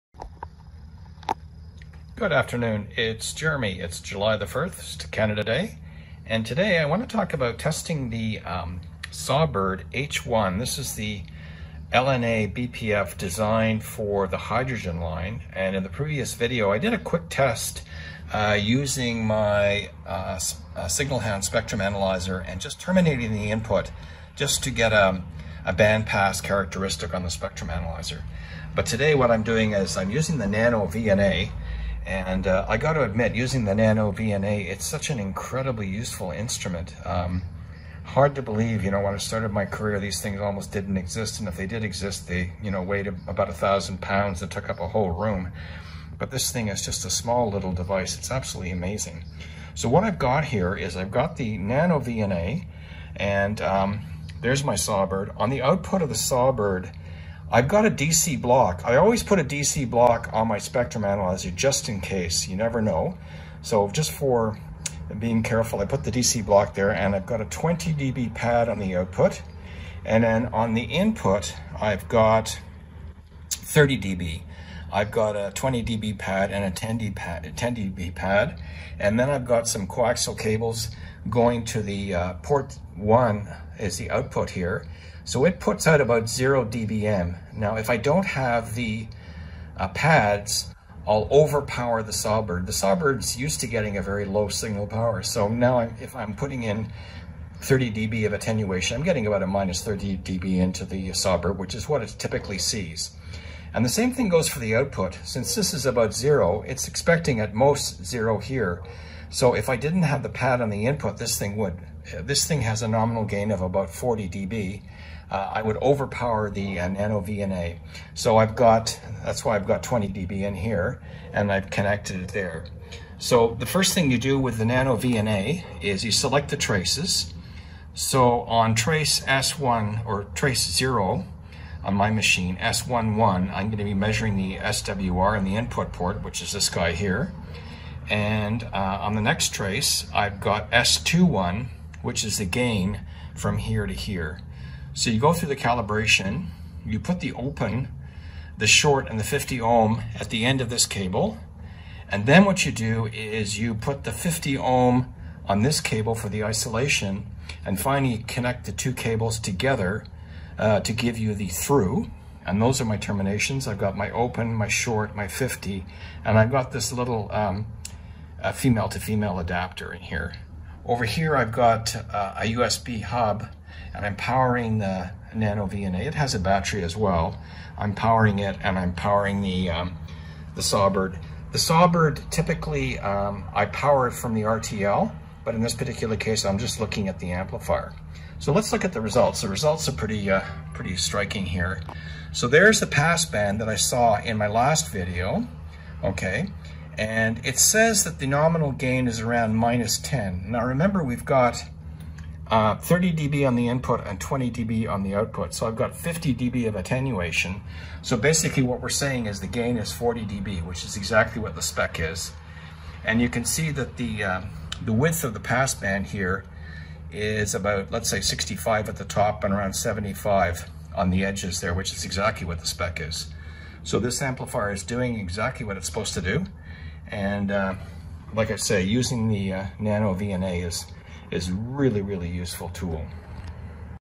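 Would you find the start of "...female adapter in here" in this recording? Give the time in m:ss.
2:48.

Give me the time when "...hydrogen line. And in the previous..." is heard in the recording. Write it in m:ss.
0:14.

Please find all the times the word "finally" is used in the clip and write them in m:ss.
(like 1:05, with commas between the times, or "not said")
2:37.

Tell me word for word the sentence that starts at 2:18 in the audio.
And uh, on the next trace, I've got S21, which is the gain from here to here.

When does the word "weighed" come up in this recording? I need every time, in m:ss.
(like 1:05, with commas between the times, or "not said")
0:42.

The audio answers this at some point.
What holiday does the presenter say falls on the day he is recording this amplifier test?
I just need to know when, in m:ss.
0:05.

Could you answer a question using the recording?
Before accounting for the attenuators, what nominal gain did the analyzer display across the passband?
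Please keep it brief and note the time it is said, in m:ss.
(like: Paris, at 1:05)
-10, at 3:19.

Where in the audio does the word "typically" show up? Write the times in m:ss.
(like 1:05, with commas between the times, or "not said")
1:42, 3:02.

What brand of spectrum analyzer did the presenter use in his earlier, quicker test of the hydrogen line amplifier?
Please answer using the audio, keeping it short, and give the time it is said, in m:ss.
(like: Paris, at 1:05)
Signal Hound, at 0:20.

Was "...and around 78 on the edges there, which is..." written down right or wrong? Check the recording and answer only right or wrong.
wrong.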